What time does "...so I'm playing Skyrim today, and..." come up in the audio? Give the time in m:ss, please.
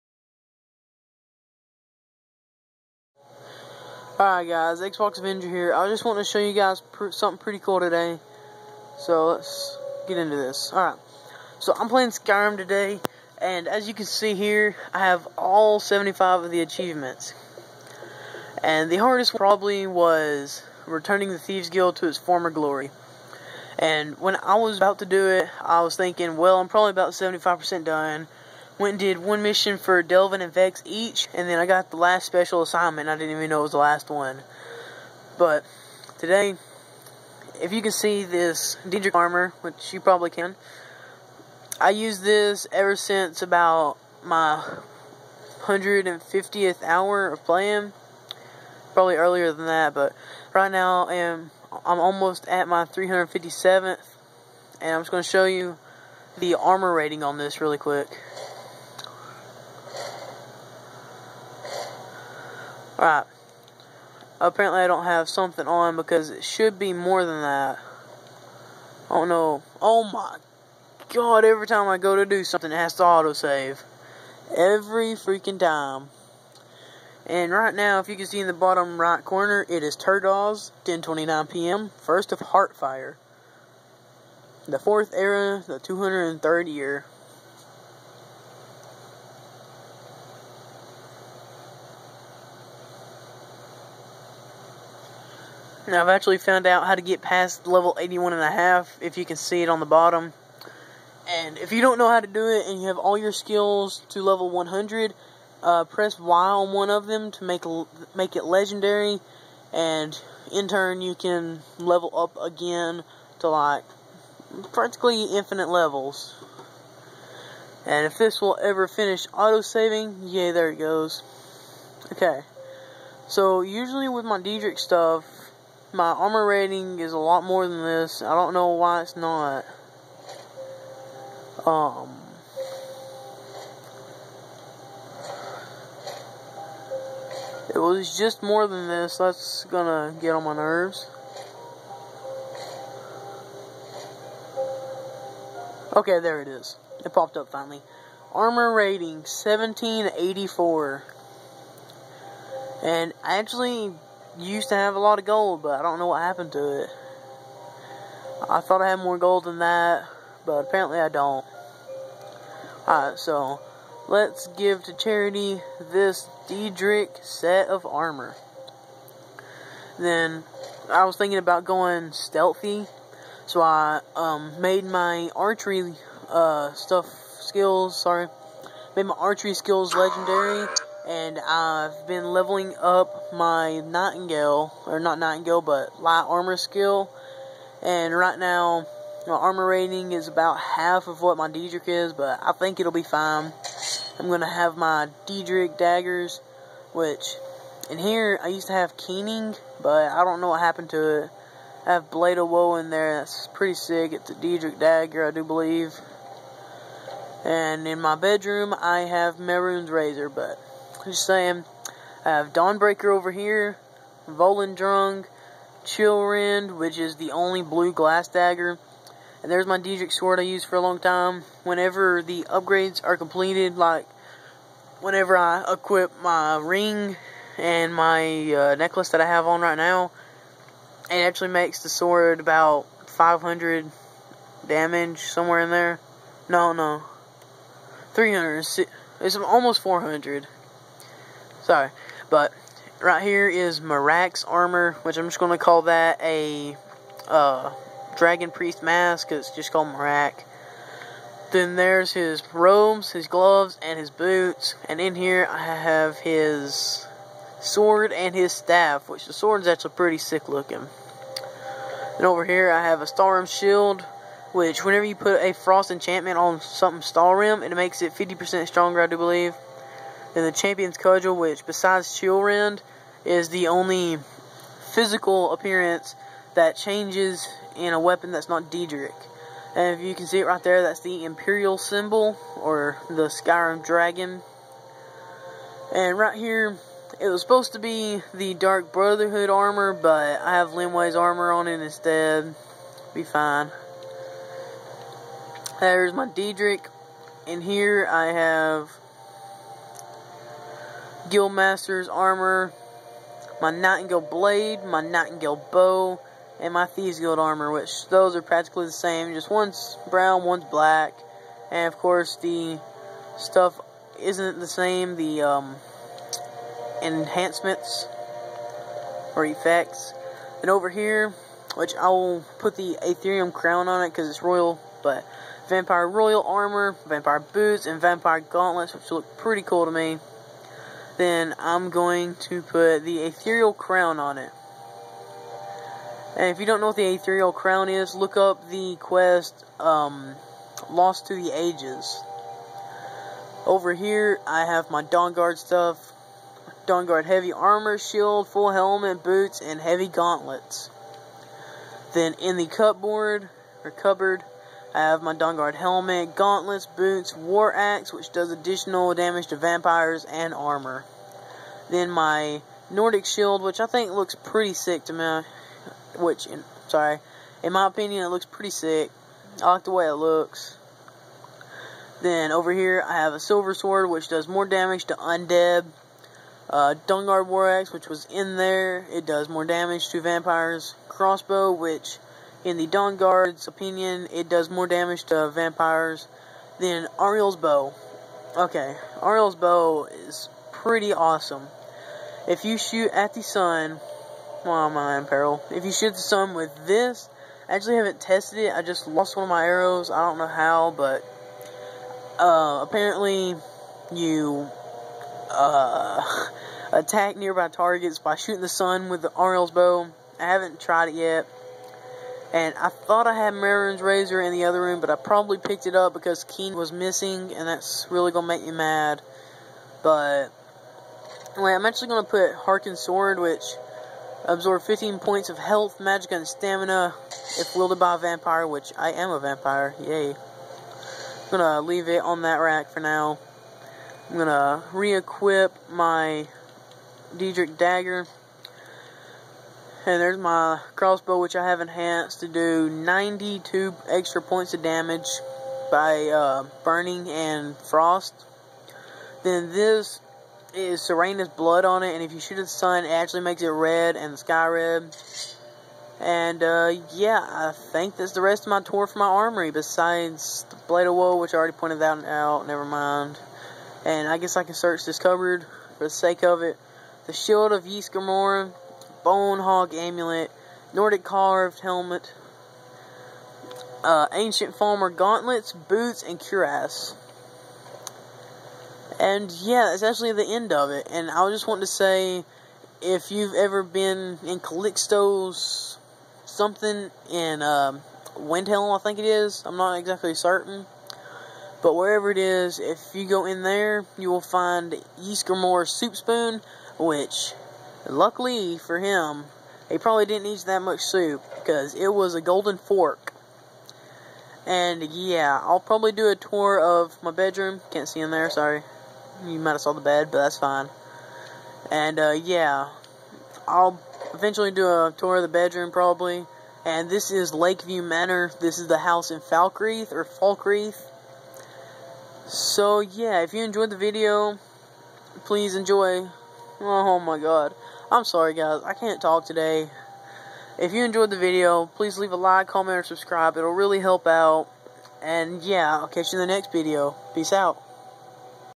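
0:11.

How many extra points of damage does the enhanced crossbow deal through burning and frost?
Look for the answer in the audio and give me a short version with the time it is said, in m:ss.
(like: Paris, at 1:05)
92, at 7:22.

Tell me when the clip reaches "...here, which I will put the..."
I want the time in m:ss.
5:20.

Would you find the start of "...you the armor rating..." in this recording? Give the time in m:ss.
0:55.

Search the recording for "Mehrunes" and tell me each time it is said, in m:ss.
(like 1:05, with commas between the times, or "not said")
3:29, 6:53.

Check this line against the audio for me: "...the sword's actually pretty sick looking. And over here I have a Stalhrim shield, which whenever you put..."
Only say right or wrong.
right.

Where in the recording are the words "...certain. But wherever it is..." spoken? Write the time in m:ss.
8:10.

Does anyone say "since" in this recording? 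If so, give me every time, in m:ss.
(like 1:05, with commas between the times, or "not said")
0:42.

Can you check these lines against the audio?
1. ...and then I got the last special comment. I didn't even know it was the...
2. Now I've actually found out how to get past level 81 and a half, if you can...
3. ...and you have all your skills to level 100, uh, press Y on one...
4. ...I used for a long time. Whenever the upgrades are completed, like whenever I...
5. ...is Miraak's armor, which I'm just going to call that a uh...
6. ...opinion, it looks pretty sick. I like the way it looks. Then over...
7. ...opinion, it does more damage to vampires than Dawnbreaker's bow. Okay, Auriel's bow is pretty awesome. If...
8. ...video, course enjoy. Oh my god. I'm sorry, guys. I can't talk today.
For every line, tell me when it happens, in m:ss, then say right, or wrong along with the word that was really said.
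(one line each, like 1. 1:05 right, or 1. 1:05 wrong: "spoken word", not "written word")
1. 0:31 wrong: "assignment", not "comment"
2. 1:35 right
3. 1:42 right
4. 3:40 right
5. 4:03 right
6. 6:07 right
7. 6:23 wrong: "Auriel", not "Dawnbreaker"
8. 8:43 wrong: "please", not "course".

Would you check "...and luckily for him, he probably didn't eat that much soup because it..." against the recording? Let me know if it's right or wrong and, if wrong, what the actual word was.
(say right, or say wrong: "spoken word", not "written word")
right.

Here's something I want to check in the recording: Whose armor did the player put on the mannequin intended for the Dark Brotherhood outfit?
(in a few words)
Linwe's armor.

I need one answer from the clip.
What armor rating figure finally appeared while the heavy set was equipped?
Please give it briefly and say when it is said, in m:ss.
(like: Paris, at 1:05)
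1784, at 2:29.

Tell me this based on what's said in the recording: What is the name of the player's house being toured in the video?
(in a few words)
Lakeview Manor.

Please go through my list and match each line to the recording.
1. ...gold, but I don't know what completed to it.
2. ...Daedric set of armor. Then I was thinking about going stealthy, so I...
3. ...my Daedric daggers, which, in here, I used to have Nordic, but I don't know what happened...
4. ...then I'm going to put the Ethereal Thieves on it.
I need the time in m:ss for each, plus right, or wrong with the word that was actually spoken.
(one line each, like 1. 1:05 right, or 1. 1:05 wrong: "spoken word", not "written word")
1. 2:35 wrong: "happened", not "completed"
2. 2:46 right
3. 3:14 wrong: "Keening", not "Nordic"
4. 5:31 wrong: "Crown", not "Thieves".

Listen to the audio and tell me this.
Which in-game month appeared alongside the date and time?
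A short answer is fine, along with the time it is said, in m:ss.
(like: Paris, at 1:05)
Heartfire, at 1:22.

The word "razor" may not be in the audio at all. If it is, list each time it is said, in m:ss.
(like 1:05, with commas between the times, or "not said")
3:29, 6:54.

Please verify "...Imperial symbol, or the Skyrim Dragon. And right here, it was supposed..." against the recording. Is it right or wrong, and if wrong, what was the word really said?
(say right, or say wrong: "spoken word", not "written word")
right.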